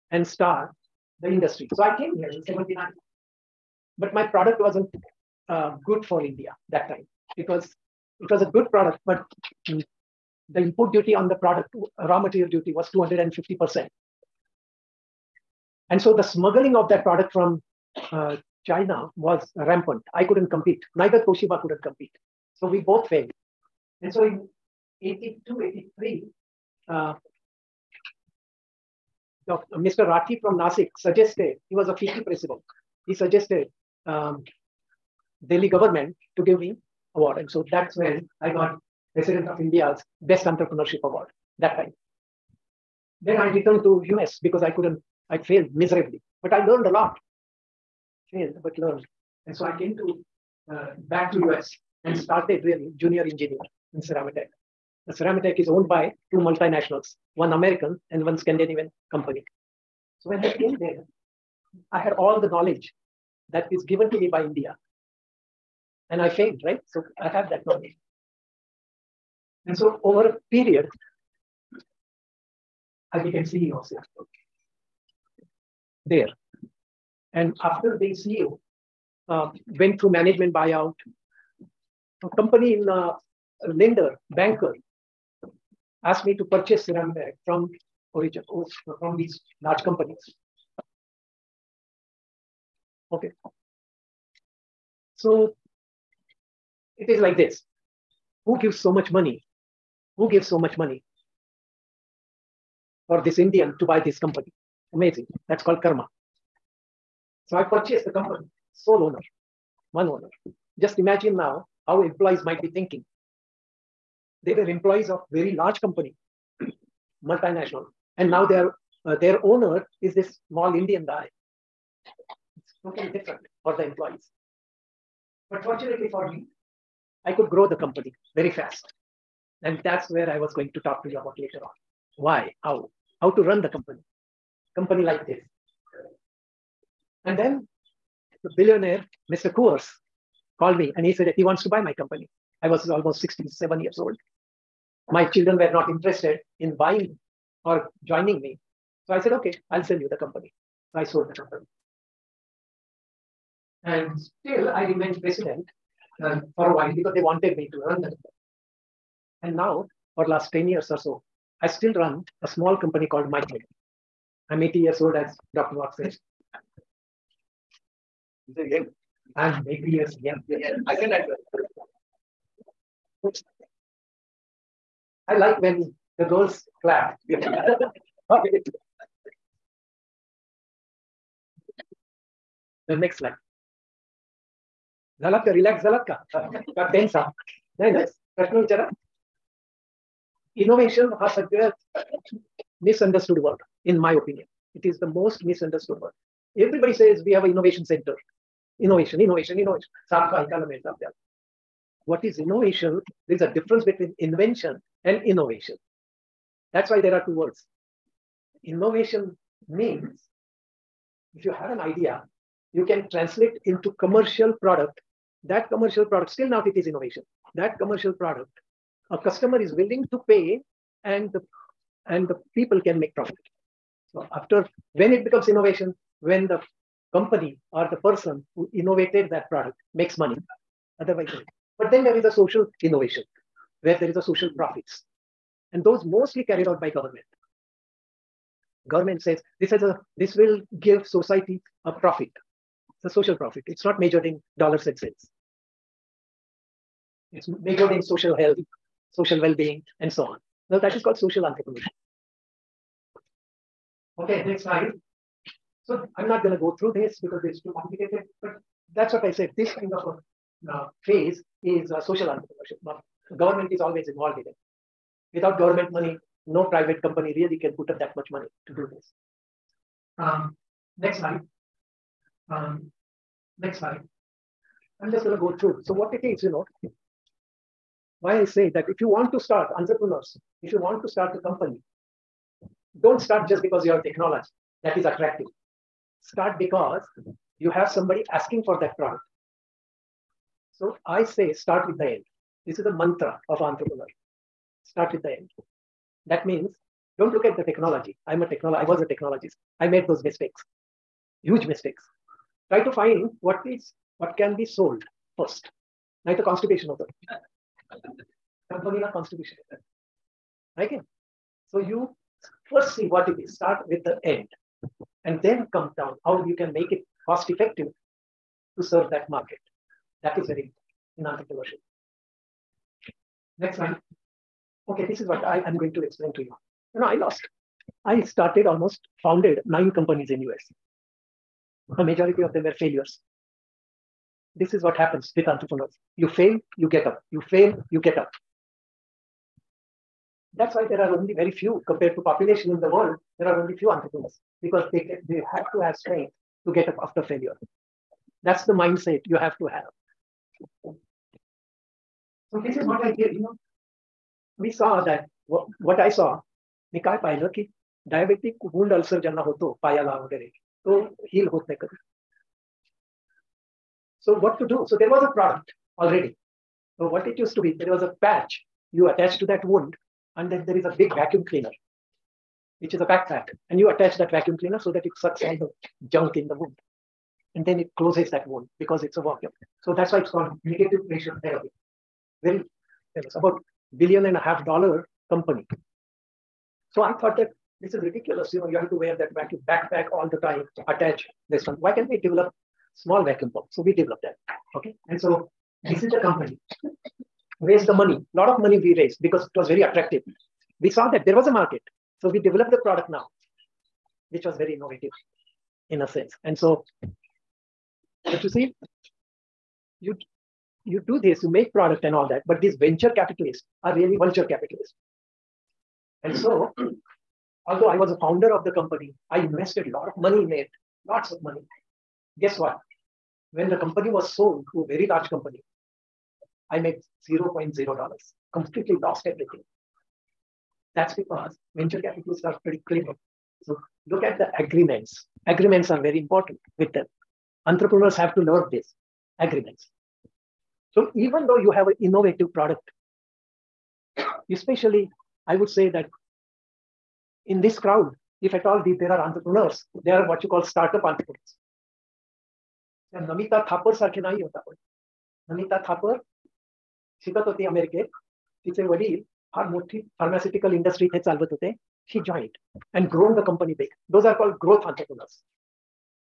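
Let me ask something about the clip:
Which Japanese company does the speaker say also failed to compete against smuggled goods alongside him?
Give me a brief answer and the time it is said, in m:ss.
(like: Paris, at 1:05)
Toshiba, at 0:21.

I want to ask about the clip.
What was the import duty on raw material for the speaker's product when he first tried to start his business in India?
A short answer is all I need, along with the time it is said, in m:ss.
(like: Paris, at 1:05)
250%, at 0:12.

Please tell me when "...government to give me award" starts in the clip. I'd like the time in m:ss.
0:35.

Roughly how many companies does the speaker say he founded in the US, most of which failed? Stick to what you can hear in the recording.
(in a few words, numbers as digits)
9.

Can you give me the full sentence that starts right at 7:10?
That's because venture capitalists are pretty clever.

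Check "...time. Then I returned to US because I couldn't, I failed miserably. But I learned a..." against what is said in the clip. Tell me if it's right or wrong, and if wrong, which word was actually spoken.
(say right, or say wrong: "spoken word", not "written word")
right.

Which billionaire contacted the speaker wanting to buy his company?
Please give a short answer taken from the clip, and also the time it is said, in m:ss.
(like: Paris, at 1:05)
Mr. Coors, at 2:19.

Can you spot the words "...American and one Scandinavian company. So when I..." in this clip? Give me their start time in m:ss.
0:57.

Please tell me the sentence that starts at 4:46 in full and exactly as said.
Start because you have somebody asking for that product.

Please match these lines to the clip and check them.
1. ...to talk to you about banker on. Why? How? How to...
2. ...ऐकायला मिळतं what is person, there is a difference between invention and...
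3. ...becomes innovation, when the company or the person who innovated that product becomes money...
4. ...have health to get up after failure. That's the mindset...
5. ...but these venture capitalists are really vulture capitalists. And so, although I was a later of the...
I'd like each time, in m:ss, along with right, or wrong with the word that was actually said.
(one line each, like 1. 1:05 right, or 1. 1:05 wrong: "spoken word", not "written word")
1. 2:10 wrong: "later", not "banker"
2. 3:20 wrong: "innovation", not "person"
3. 3:45 wrong: "makes", not "becomes"
4. 5:45 wrong: "strength", not "health"
5. 6:52 wrong: "founder", not "later".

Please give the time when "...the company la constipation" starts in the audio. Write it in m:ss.
5:06.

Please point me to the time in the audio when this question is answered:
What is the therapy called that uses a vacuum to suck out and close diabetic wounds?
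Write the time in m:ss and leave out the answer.
6:20.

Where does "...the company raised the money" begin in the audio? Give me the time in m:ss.
6:36.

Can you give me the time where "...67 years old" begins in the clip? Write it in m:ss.
2:23.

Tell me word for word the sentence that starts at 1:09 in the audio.
And so over a period, I became CEO of also There.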